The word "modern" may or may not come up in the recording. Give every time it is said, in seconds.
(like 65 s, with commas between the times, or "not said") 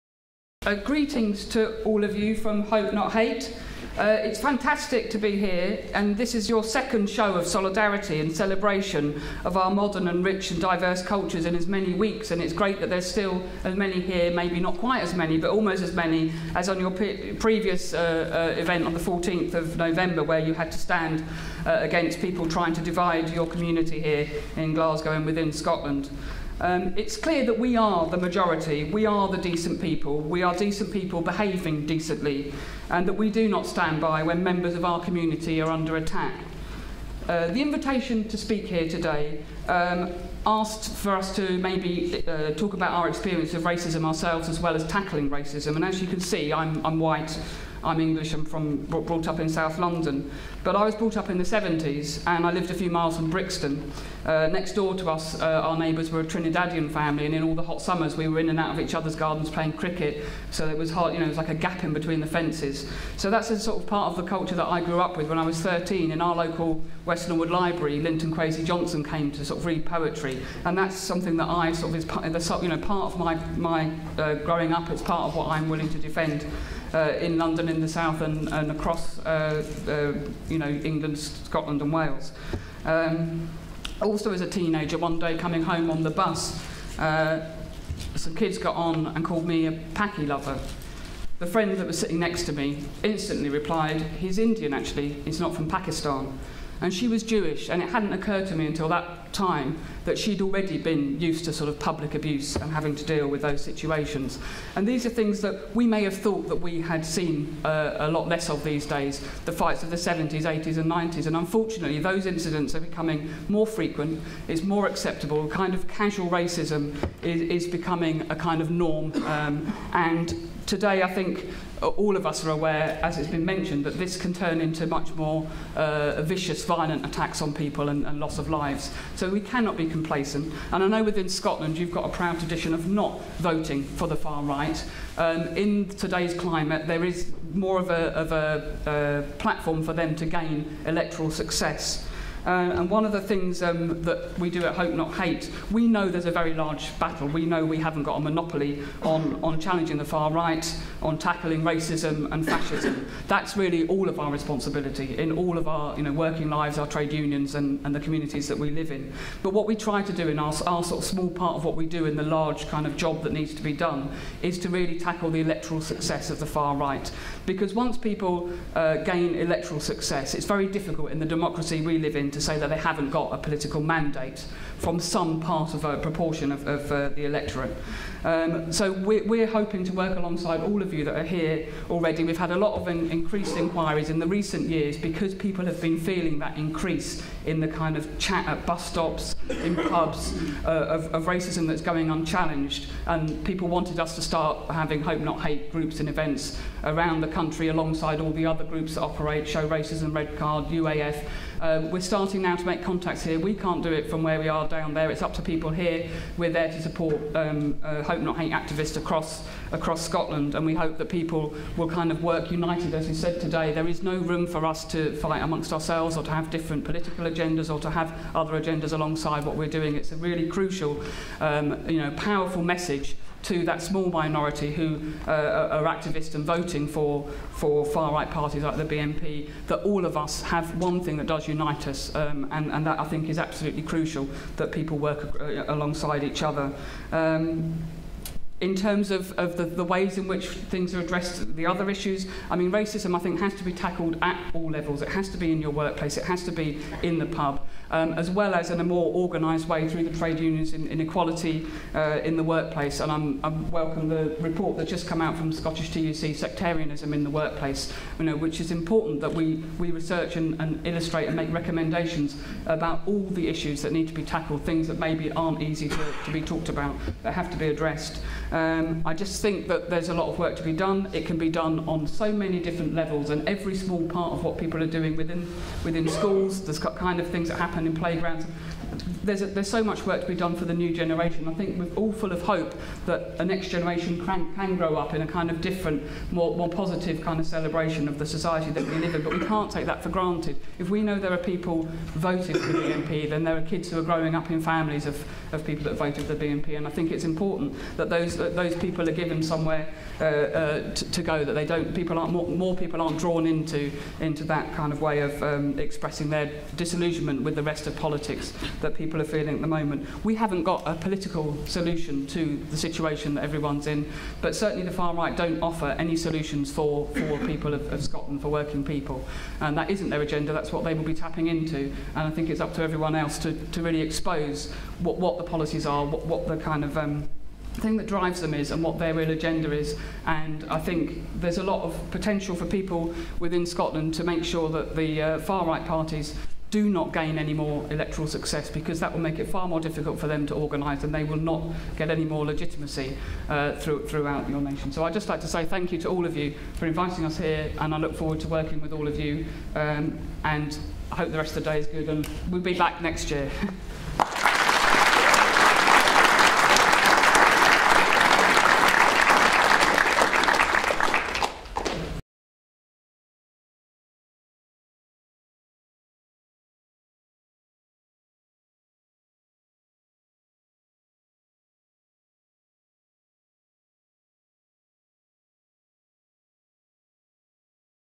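9 s.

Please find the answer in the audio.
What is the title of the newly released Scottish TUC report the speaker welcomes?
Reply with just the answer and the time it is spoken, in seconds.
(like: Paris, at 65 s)
Sectarianism in the Workplace, at 256 s.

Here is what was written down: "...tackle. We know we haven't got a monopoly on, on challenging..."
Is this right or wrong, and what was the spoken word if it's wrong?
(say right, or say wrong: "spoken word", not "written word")
wrong: "battle", not "tackle".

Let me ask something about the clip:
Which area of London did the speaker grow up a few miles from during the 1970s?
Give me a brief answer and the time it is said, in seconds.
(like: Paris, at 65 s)
Brixton, at 53 s.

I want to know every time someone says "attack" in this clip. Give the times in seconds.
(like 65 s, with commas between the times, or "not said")
35 s, 127 s.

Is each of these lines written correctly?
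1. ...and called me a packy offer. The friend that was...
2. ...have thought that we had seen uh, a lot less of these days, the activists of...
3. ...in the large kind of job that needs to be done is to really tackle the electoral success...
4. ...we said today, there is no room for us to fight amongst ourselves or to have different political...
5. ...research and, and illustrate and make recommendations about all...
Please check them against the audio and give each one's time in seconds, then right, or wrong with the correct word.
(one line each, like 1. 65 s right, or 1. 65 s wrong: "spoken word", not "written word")
1. 89 s wrong: "lover", not "offer"
2. 106 s wrong: "fights", not "activists"
3. 162 s right
4. 213 s right
5. 259 s right.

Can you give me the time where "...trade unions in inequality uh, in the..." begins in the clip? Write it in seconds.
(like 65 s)
250 s.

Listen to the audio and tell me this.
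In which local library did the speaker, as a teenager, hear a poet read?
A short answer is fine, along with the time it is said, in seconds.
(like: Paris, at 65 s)
West Norwood Library, at 67 s.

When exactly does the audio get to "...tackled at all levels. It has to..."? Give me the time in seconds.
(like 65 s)
243 s.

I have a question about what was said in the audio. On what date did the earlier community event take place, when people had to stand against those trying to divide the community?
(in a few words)
14th of November.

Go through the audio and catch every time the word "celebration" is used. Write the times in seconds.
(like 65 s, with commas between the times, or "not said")
8 s, 287 s.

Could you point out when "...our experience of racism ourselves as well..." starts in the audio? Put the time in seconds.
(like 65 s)
42 s.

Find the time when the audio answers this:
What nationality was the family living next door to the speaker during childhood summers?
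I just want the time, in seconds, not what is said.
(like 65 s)
56 s.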